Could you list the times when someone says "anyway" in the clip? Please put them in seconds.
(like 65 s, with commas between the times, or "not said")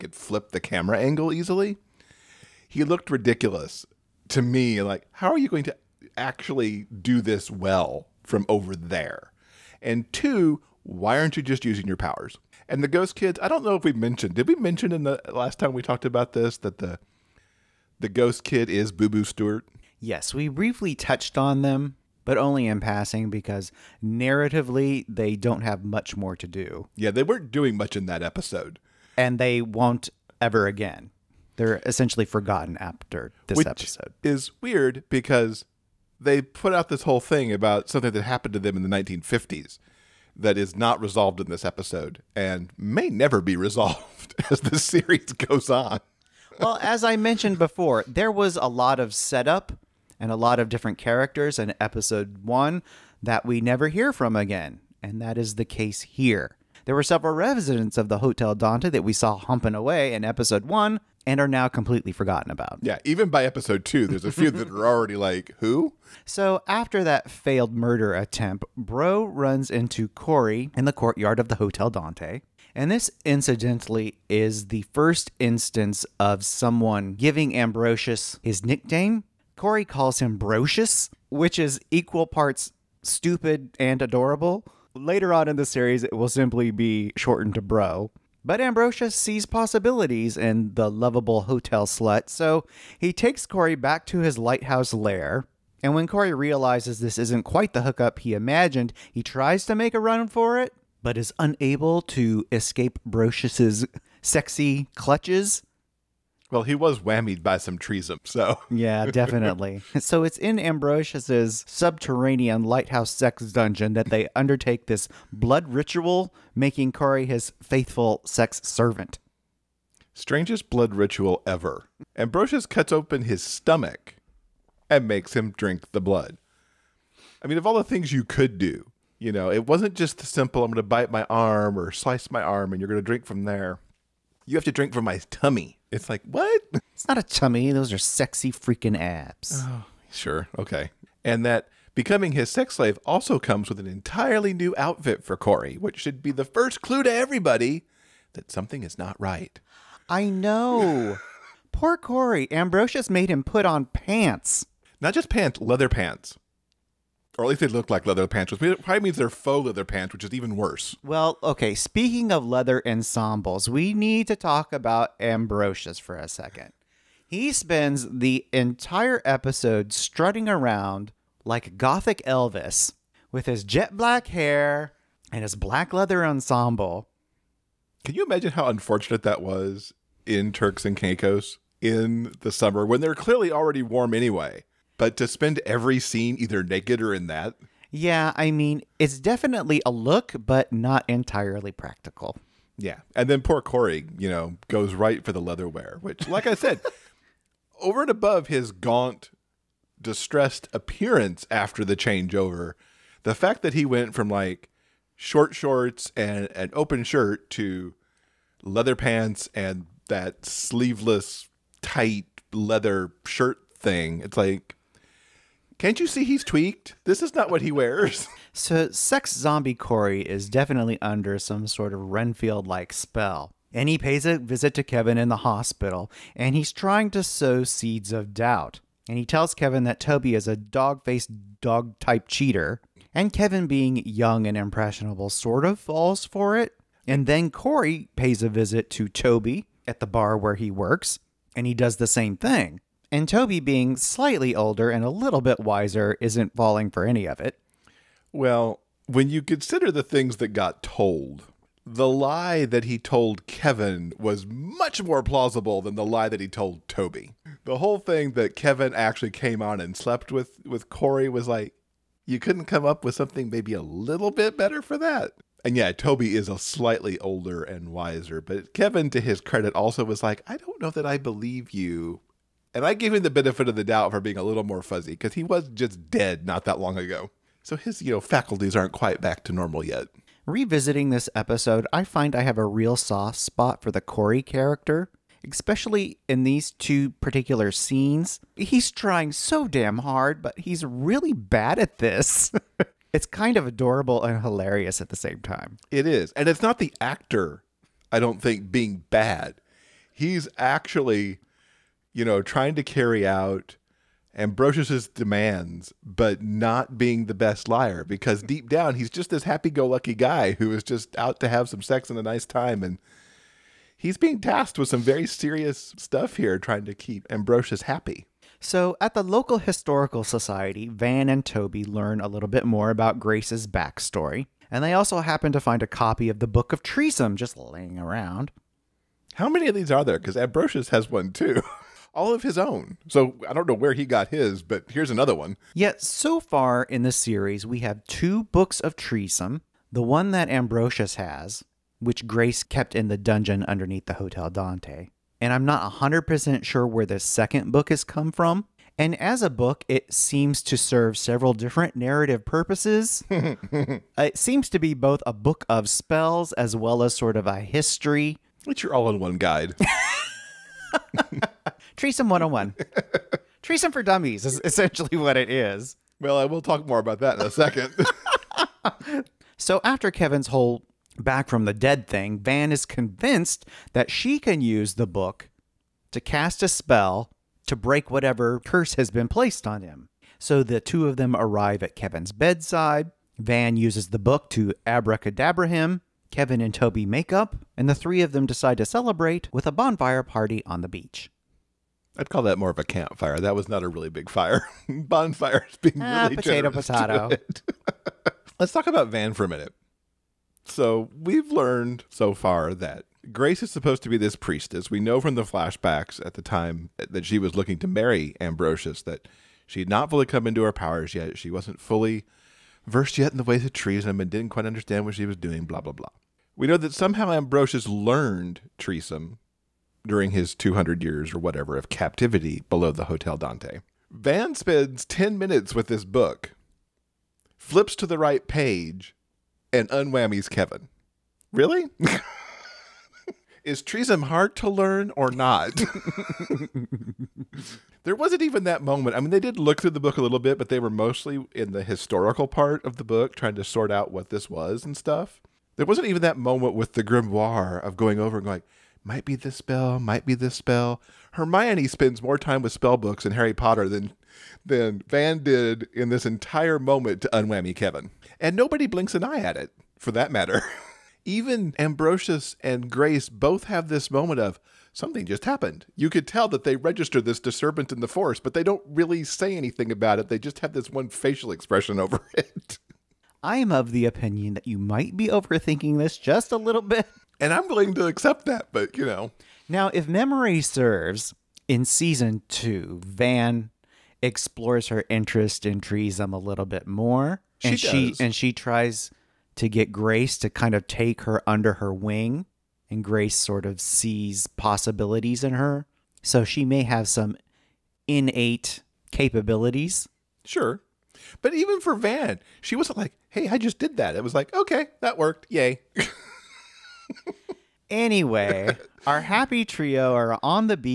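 184 s, 507 s.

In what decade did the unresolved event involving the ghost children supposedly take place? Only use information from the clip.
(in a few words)
1950s.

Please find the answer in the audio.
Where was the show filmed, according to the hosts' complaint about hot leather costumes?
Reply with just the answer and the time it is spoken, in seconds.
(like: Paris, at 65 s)
Turks and Caicos, at 180 s.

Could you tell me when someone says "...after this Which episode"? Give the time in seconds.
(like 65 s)
32 s.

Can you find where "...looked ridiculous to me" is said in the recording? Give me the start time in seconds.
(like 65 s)
2 s.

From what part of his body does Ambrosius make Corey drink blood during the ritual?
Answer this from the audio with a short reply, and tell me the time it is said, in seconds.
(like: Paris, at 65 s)
His stomach, at 123 s.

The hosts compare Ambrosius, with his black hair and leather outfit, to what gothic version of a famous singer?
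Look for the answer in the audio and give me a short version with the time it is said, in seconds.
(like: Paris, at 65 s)
Gothic Elvis, at 171 s.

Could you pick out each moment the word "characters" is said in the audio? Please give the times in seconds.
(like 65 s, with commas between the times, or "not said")
50 s, 284 s.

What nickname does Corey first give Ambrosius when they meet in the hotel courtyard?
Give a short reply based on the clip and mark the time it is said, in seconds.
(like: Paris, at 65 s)
Brocious, at 80 s.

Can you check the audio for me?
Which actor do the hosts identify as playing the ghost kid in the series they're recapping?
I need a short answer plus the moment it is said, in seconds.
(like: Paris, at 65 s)
Boo Boo Stewart, at 18 s.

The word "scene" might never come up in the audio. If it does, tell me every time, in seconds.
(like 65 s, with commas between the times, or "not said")
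185 s, 287 s.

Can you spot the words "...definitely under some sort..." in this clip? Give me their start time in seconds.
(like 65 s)
220 s.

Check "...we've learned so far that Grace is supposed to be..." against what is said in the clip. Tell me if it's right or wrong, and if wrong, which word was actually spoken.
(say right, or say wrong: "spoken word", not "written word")
right.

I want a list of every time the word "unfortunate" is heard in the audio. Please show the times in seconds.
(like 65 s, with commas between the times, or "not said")
178 s.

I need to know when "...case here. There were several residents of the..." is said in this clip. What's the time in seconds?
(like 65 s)
55 s.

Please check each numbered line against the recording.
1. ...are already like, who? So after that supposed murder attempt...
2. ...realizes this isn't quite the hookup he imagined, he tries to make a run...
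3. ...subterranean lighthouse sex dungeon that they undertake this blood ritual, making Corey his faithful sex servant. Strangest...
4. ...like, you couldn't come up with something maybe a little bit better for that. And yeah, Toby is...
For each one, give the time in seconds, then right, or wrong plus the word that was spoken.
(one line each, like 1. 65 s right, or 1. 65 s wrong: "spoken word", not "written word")
1. 64 s wrong: "failed", not "supposed"
2. 96 s right
3. 111 s right
4. 261 s right.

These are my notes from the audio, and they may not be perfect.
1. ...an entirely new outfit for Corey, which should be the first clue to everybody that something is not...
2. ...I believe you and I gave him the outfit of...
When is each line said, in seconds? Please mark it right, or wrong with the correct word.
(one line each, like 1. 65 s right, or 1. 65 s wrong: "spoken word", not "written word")
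1. 143 s right
2. 271 s wrong: "benefit", not "outfit".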